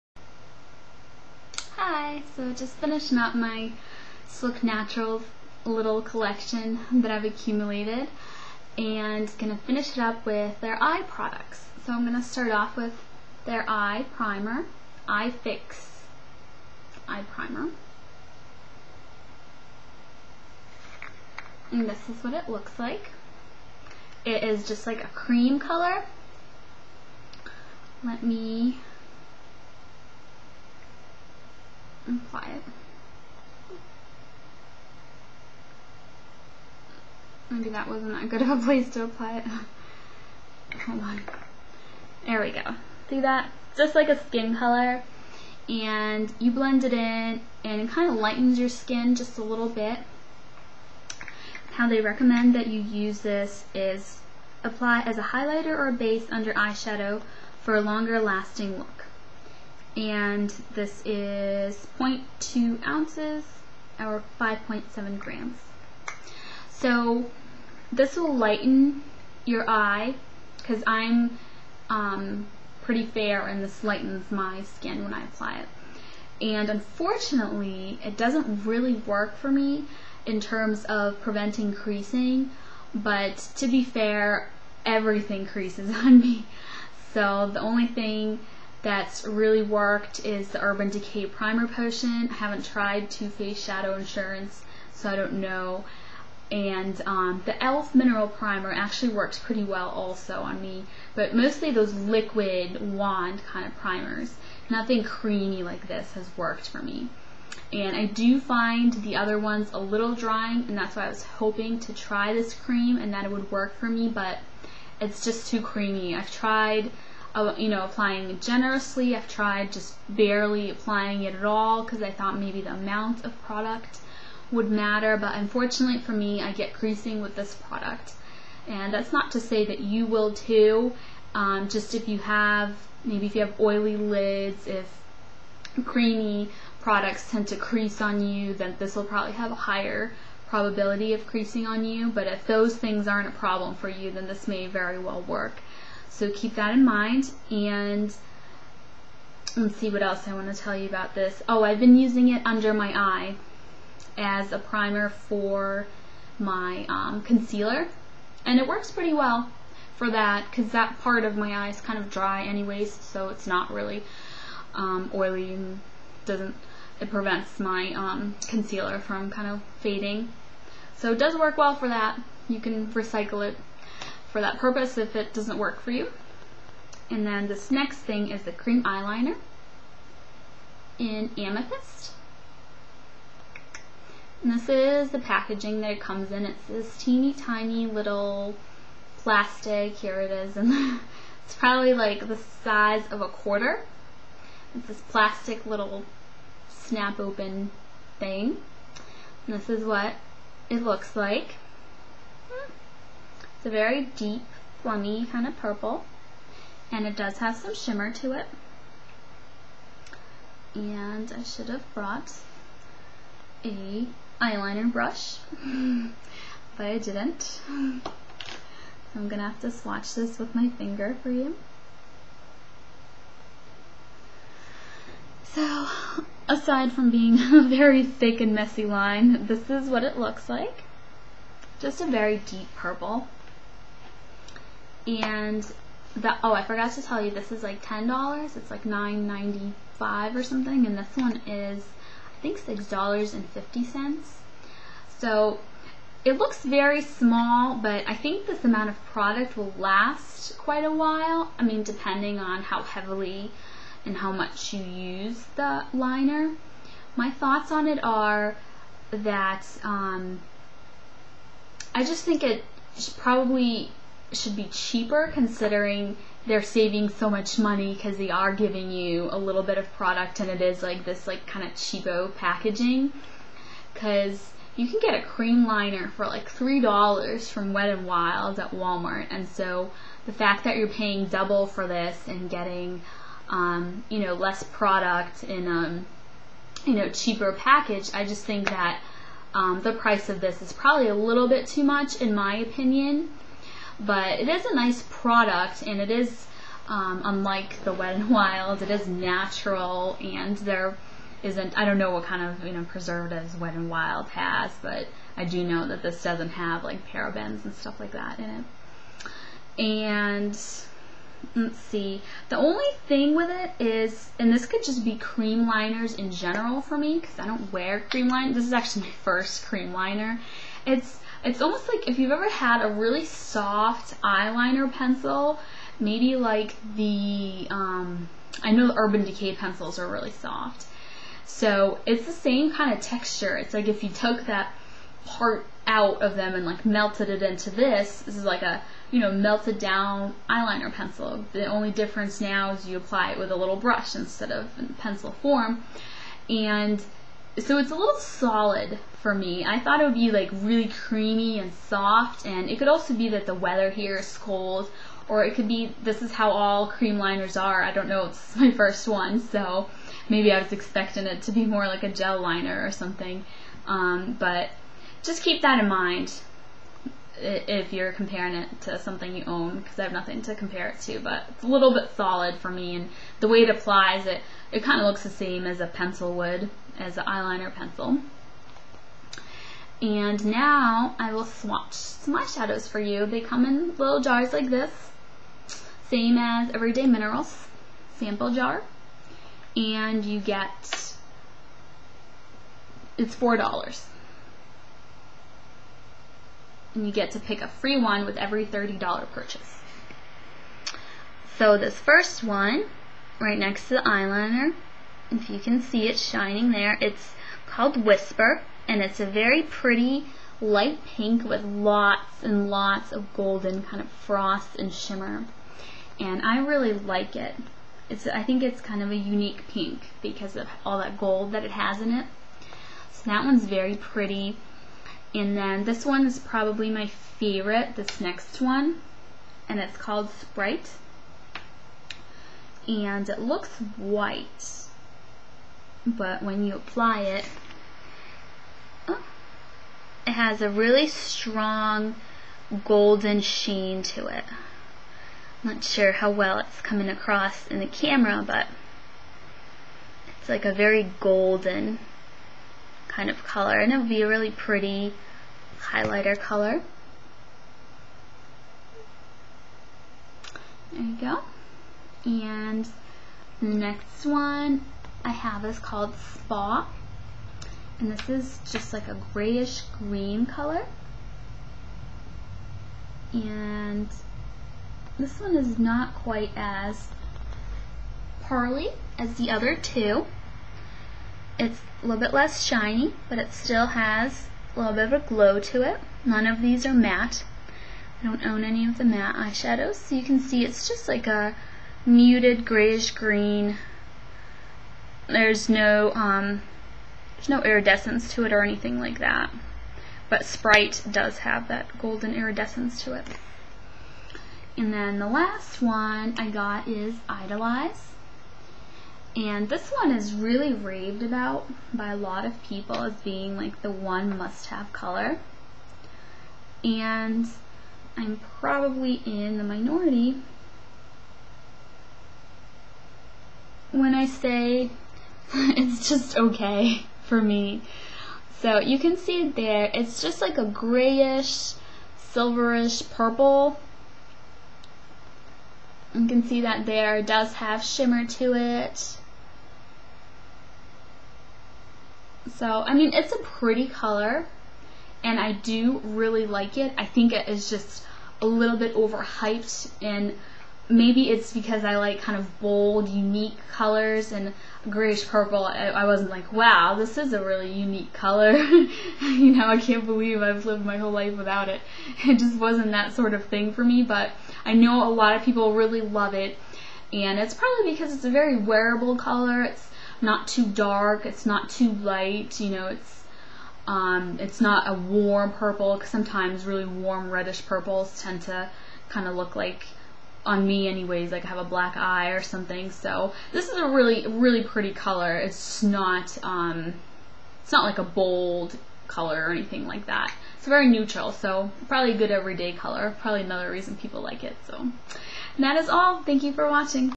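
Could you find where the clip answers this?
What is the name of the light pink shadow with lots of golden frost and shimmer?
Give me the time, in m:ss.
6:48.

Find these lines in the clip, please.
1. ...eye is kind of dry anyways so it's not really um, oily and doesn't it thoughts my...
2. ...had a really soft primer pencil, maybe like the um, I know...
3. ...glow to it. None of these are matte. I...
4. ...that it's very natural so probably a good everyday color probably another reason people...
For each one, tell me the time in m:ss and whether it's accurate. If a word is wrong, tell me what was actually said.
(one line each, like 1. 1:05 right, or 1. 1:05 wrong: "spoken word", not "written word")
1. 2:41 wrong: "prevents", not "thoughts"
2. 5:22 wrong: "eyeliner", not "primer"
3. 8:05 right
4. 9:50 wrong: "neutral", not "natural".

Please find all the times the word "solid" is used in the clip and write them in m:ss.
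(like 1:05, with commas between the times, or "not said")
5:48, 6:12.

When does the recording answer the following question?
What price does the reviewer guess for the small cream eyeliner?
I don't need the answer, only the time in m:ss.
4:02.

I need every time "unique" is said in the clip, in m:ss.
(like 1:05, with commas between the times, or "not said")
6:59, 9:13, 9:17.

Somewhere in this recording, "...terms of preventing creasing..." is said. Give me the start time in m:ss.
1:20.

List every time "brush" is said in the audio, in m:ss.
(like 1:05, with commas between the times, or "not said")
3:34, 5:43.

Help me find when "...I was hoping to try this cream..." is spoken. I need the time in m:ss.
1:51.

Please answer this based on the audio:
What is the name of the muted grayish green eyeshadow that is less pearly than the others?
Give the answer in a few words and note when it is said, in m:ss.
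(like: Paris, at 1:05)
Spa, at 7:46.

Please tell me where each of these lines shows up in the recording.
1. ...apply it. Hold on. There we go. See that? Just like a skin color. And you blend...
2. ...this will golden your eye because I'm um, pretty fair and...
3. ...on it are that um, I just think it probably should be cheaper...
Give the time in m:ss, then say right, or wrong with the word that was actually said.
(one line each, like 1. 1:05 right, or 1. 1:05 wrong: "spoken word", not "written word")
1. 0:39 right
2. 1:07 wrong: "lighten", not "golden"
3. 4:17 right.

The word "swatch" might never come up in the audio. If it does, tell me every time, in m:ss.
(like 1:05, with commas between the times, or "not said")
3:39, 6:21.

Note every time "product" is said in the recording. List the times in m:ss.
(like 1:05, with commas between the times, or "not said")
0:11, 2:03, 2:07, 2:16, 4:09, 4:29, 4:44, 4:55.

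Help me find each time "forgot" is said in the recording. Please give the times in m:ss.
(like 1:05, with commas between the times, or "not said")
3:56.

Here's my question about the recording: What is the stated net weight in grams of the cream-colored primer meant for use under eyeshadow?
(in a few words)
5.7 grams.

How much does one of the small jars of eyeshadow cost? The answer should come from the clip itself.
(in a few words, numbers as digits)
$4.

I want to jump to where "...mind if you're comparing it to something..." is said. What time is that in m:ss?
6:05.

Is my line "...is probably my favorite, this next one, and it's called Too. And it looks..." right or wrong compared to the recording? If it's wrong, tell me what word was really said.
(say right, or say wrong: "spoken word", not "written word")
wrong: "Sprite", not "Too".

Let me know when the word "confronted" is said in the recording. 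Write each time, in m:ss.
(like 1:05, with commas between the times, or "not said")
not said.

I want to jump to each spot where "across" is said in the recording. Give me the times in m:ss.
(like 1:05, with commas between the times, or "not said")
7:27.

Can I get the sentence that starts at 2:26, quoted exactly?
So keep that in mind and let's see what else I want to tell you about this.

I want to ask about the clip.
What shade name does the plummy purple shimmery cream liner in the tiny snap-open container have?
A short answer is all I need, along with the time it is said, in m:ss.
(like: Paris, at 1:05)
Amethyst, at 3:01.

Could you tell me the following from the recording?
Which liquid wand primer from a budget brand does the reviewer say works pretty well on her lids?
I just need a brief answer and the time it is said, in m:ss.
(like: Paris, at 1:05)
e.l.f. Mineral Primer, at 1:37.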